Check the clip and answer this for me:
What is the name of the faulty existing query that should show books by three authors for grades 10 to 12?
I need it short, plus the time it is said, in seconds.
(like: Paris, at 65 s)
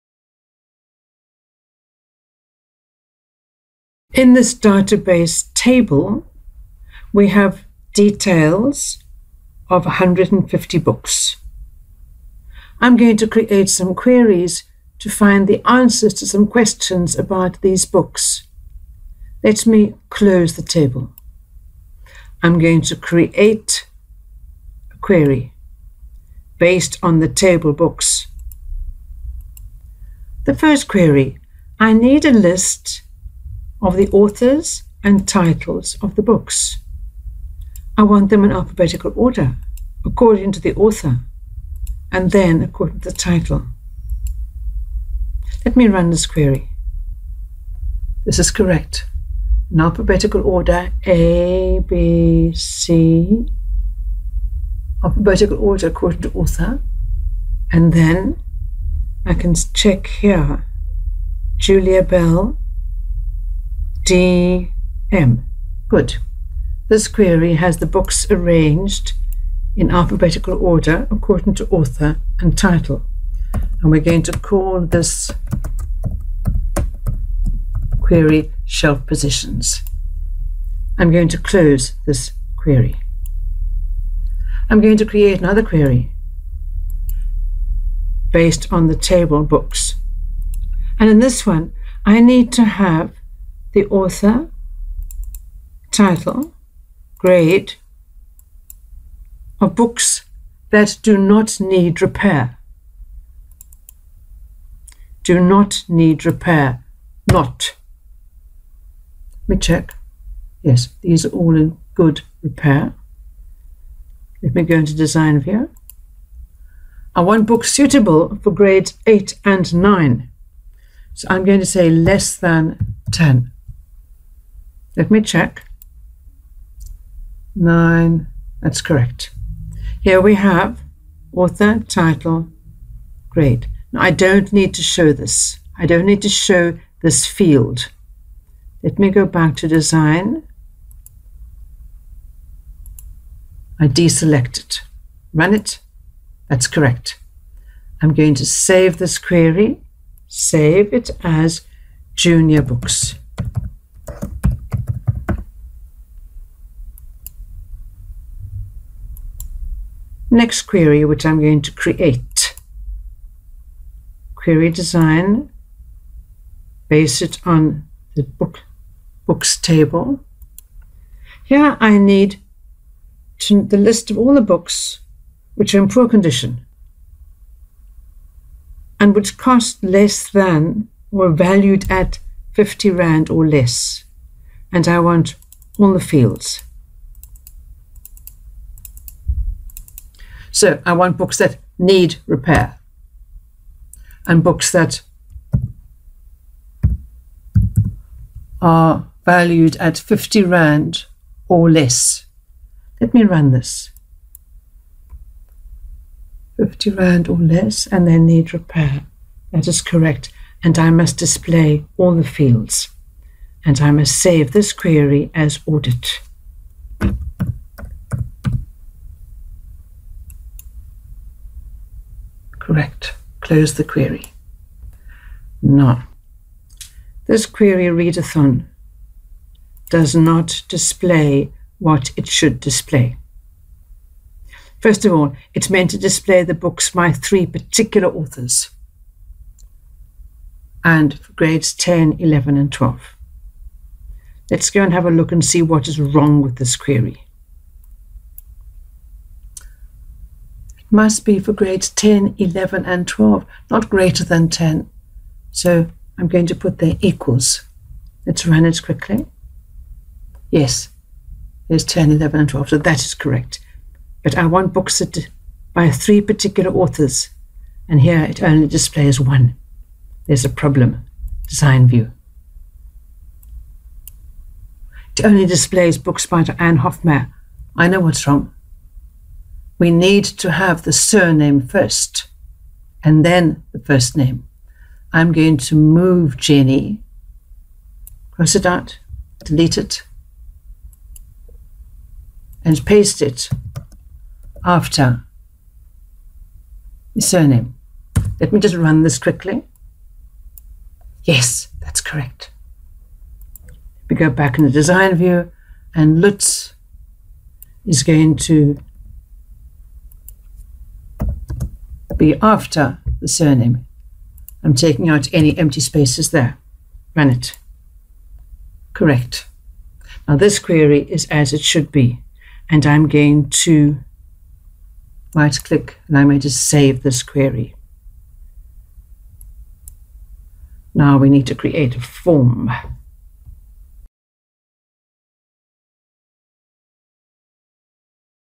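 readathon, at 227 s.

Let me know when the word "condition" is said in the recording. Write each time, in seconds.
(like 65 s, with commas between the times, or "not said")
176 s.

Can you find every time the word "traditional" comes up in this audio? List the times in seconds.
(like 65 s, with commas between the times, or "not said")
not said.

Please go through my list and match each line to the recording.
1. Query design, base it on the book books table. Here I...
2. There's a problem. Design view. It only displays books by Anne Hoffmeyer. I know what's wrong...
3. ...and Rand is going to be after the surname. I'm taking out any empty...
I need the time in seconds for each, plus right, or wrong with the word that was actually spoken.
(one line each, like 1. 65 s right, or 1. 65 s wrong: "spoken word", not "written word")
1. 164 s right
2. 270 s right
3. 305 s wrong: "Lutz", not "Rand".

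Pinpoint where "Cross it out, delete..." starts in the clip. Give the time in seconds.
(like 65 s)
288 s.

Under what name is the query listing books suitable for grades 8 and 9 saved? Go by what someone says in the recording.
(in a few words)
junior books.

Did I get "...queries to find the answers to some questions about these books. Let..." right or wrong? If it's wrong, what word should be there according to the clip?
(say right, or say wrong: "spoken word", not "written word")
right.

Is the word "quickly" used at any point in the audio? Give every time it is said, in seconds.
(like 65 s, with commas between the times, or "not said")
258 s, 299 s.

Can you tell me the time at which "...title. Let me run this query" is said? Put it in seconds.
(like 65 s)
43 s.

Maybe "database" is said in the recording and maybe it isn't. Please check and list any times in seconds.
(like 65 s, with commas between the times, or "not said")
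4 s.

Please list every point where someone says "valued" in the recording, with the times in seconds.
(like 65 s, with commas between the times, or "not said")
181 s, 199 s.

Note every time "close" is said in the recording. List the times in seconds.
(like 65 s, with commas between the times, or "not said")
20 s, 81 s, 223 s.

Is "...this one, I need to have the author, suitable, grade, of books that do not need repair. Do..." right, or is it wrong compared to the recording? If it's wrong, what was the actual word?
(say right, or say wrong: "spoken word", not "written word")
wrong: "title", not "suitable".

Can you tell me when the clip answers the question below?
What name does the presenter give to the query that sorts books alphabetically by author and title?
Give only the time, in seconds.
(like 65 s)
78 s.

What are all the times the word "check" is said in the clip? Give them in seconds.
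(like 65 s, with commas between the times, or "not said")
59 s, 109 s, 125 s.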